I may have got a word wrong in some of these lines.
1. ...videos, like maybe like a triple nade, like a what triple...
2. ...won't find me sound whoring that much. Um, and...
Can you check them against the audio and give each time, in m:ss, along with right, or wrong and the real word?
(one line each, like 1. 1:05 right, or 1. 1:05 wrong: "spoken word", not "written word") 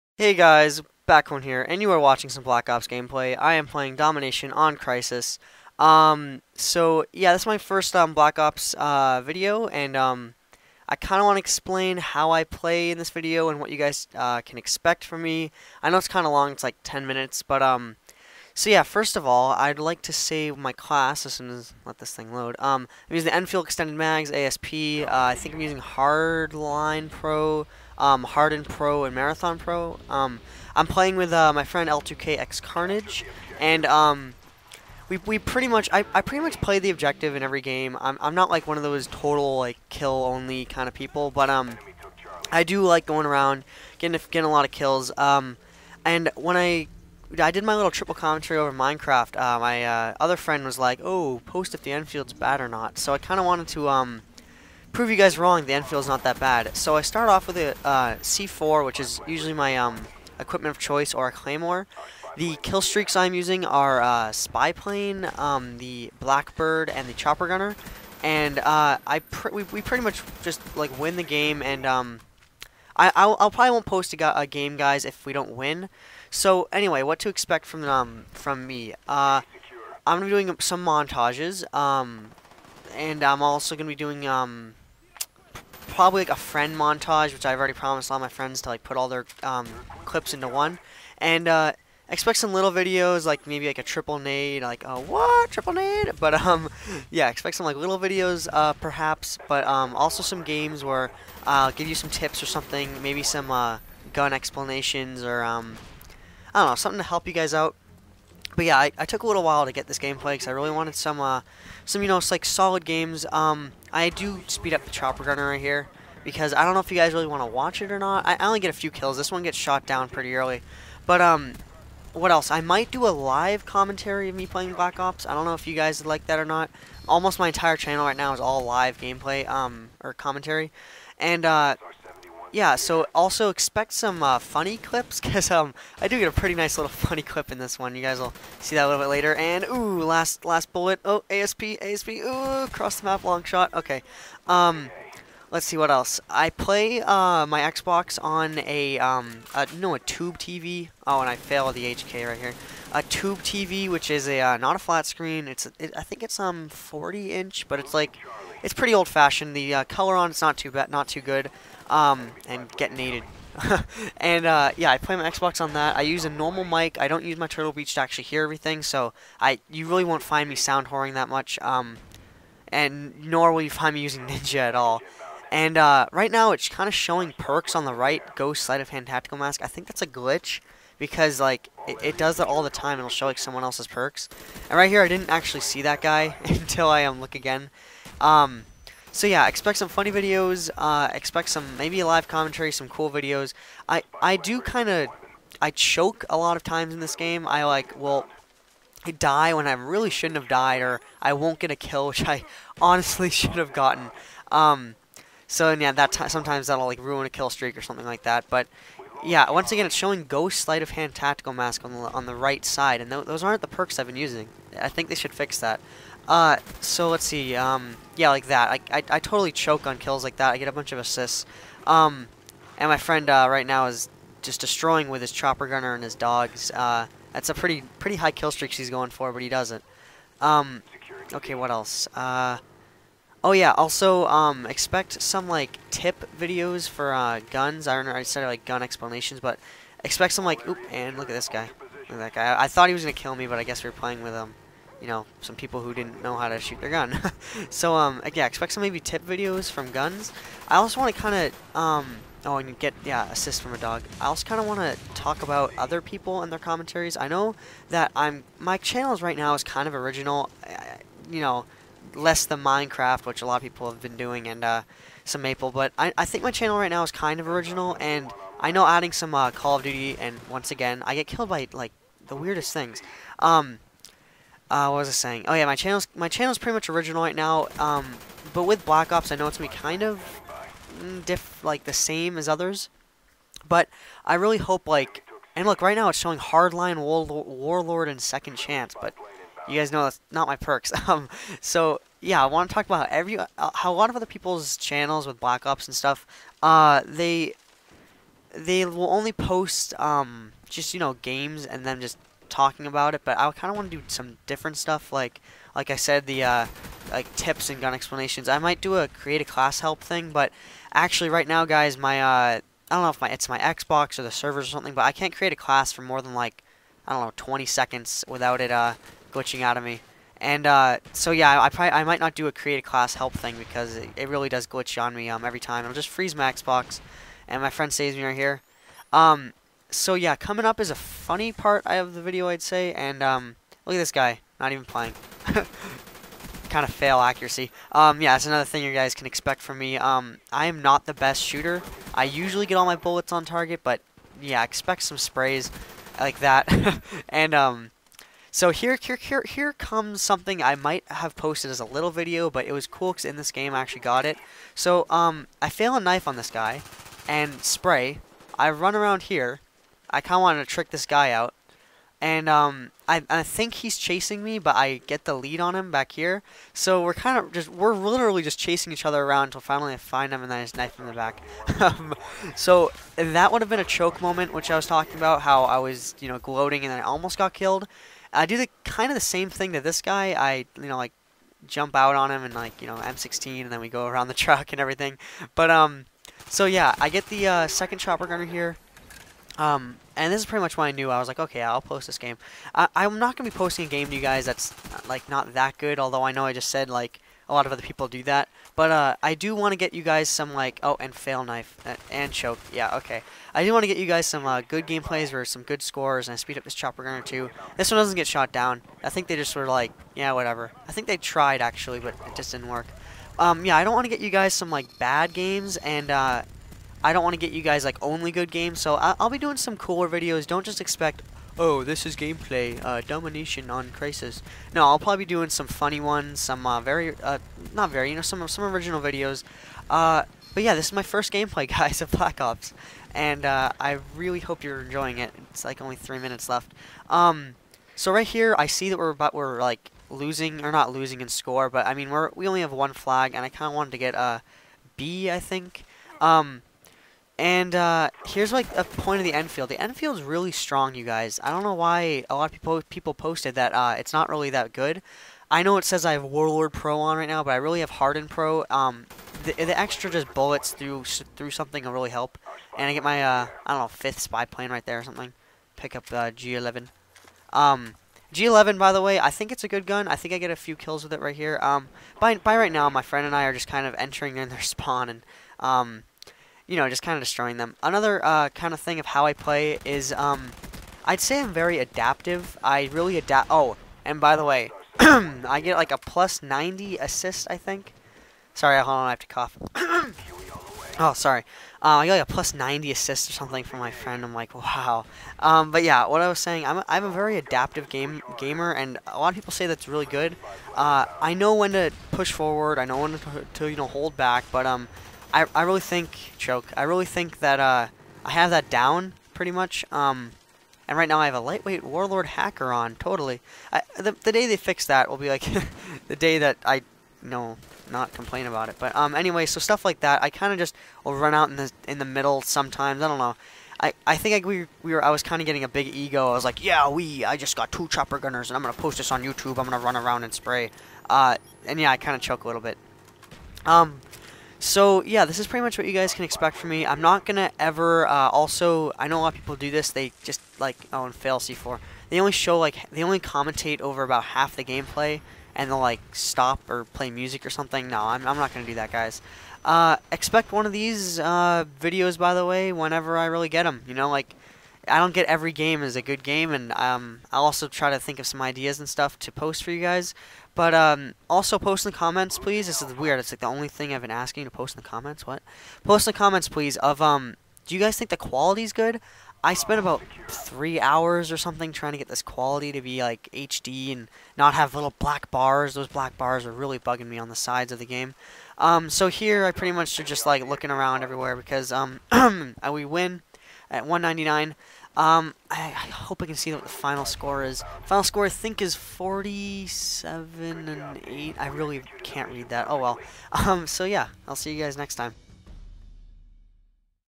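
1. 1:32 right
2. 2:50 right.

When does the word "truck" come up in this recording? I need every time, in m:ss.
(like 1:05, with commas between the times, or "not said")
6:24.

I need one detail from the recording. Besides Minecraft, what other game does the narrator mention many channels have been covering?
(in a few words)
Maple.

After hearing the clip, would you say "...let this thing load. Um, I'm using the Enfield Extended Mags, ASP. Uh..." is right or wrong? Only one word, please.
right.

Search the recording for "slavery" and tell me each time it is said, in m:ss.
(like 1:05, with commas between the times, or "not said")
not said.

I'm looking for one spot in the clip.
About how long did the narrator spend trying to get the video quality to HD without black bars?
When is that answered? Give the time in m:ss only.
9:30.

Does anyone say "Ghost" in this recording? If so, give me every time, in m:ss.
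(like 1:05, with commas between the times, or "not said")
2:58, 3:30.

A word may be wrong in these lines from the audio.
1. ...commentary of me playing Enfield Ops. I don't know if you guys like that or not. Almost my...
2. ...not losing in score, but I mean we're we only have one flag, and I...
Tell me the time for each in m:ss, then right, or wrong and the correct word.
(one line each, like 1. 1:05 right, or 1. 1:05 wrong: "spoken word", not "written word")
1. 2:03 wrong: "Black", not "Enfield"
2. 7:20 right.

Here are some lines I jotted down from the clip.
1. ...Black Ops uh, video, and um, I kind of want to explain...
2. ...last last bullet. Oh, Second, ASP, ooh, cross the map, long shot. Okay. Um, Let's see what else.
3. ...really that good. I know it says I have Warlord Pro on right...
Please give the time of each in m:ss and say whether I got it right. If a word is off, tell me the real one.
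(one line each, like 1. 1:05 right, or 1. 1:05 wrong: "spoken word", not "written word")
1. 0:08 right
2. 2:20 wrong: "ASP", not "Second"
3. 7:34 right.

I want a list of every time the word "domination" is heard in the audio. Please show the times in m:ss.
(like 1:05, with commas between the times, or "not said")
0:03, 7:03.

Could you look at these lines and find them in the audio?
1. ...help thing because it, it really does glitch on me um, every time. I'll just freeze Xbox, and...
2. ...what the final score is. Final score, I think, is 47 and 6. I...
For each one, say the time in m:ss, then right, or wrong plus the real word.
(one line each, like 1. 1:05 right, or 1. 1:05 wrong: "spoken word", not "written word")
1. 5:23 right
2. 9:46 wrong: "8", not "6".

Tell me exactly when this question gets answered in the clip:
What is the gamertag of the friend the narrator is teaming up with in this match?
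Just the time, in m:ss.
0:31.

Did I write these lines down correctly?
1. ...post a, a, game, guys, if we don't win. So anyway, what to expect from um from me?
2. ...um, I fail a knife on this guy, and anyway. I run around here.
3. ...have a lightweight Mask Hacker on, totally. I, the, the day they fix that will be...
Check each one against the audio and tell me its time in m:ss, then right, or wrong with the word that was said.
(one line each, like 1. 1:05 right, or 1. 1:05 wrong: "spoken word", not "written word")
1. 1:13 right
2. 5:55 wrong: "spray", not "anyway"
3. 8:31 wrong: "Warlord", not "Mask".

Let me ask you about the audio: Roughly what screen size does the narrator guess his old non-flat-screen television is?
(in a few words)
40 inch.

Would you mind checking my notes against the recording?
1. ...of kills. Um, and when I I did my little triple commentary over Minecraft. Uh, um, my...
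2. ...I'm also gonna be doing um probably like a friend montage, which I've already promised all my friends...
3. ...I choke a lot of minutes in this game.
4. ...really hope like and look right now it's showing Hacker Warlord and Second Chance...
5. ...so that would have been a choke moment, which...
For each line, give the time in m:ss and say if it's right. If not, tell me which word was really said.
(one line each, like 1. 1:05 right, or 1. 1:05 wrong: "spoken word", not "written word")
1. 0:44 right
2. 1:23 right
3. 3:15 wrong: "times", not "minutes"
4. 4:44 wrong: "Hardline", not "Hacker"
5. 6:12 right.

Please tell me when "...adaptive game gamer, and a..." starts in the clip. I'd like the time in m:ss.
8:17.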